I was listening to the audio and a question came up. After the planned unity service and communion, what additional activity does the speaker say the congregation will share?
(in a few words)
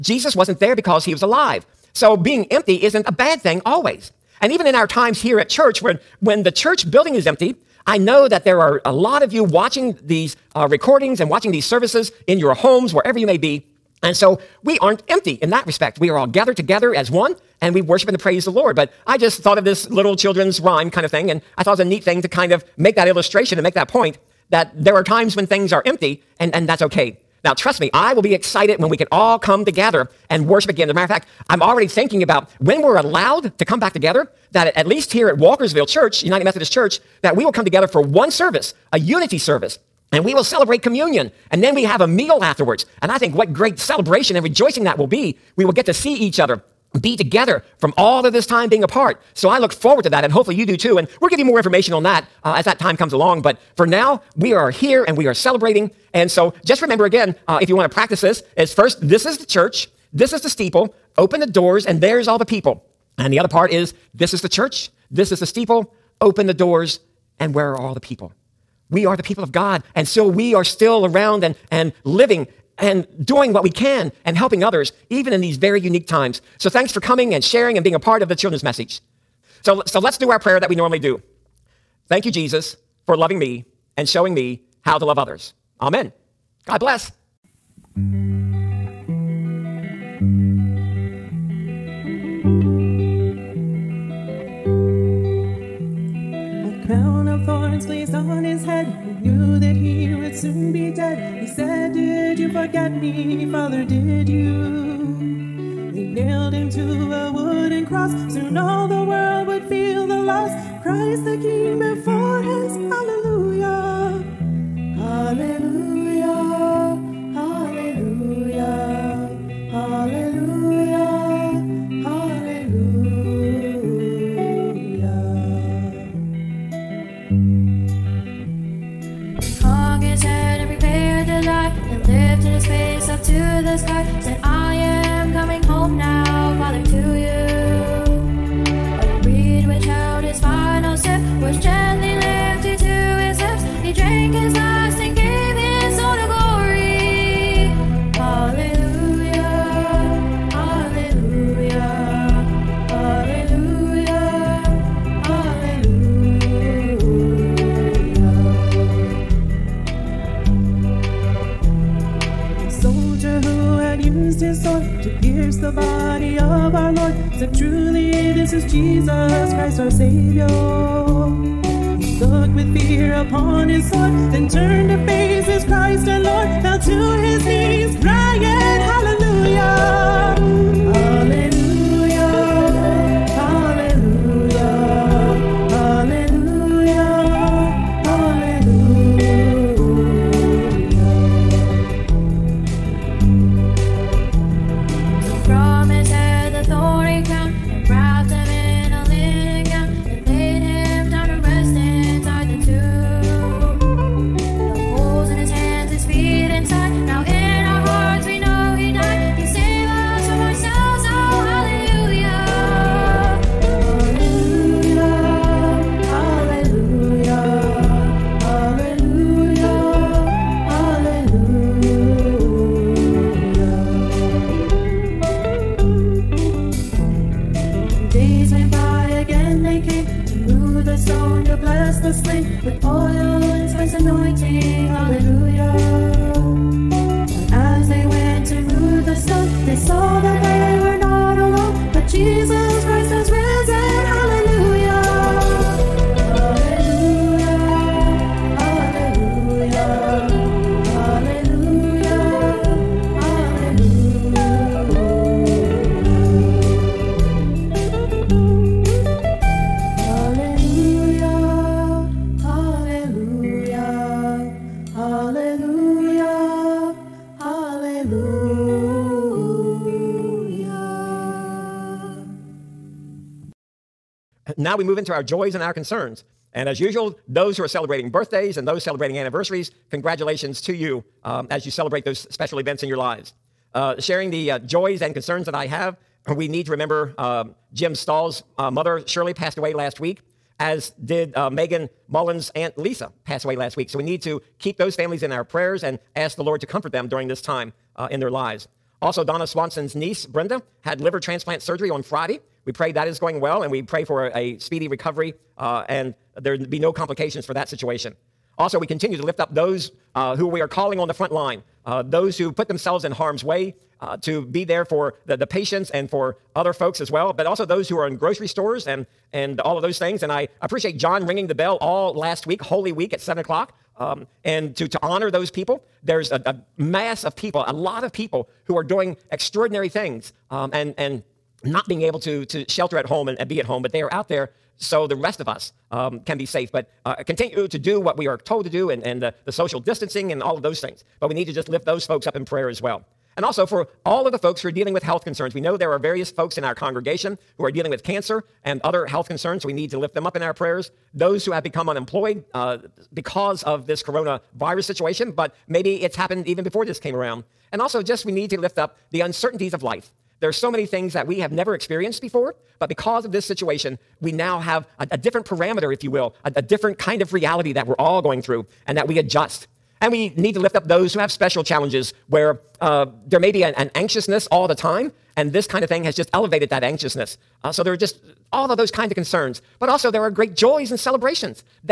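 A meal.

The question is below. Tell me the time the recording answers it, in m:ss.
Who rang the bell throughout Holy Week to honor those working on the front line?
5:20.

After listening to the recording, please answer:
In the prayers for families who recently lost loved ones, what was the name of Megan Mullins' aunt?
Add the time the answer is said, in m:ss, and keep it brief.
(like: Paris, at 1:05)
Lisa, at 4:52.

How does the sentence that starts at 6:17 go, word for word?
Uh, so there are just all of those kind of concerns, but also there are great joys and celebrations.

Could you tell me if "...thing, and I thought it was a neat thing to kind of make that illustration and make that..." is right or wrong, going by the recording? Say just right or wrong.
right.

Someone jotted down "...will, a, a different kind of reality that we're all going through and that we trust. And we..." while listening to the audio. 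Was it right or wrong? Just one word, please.
wrong.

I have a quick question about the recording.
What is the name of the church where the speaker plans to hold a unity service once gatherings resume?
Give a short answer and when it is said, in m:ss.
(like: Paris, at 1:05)
Walkersville Church, at 0:35.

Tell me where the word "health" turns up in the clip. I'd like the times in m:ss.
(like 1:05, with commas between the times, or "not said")
5:45, 5:49.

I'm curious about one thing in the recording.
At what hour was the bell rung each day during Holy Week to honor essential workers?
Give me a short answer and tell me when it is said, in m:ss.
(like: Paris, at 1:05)
7 o'clock, at 5:23.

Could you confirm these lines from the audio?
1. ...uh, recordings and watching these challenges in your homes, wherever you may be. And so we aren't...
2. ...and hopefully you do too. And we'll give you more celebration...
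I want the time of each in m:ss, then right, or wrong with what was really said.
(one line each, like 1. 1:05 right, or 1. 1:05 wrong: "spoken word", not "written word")
1. 0:10 wrong: "services", not "challenges"
2. 0:50 wrong: "information", not "celebration".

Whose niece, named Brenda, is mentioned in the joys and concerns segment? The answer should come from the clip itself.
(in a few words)
Donna Swanson.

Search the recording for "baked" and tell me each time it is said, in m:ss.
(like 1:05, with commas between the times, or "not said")
not said.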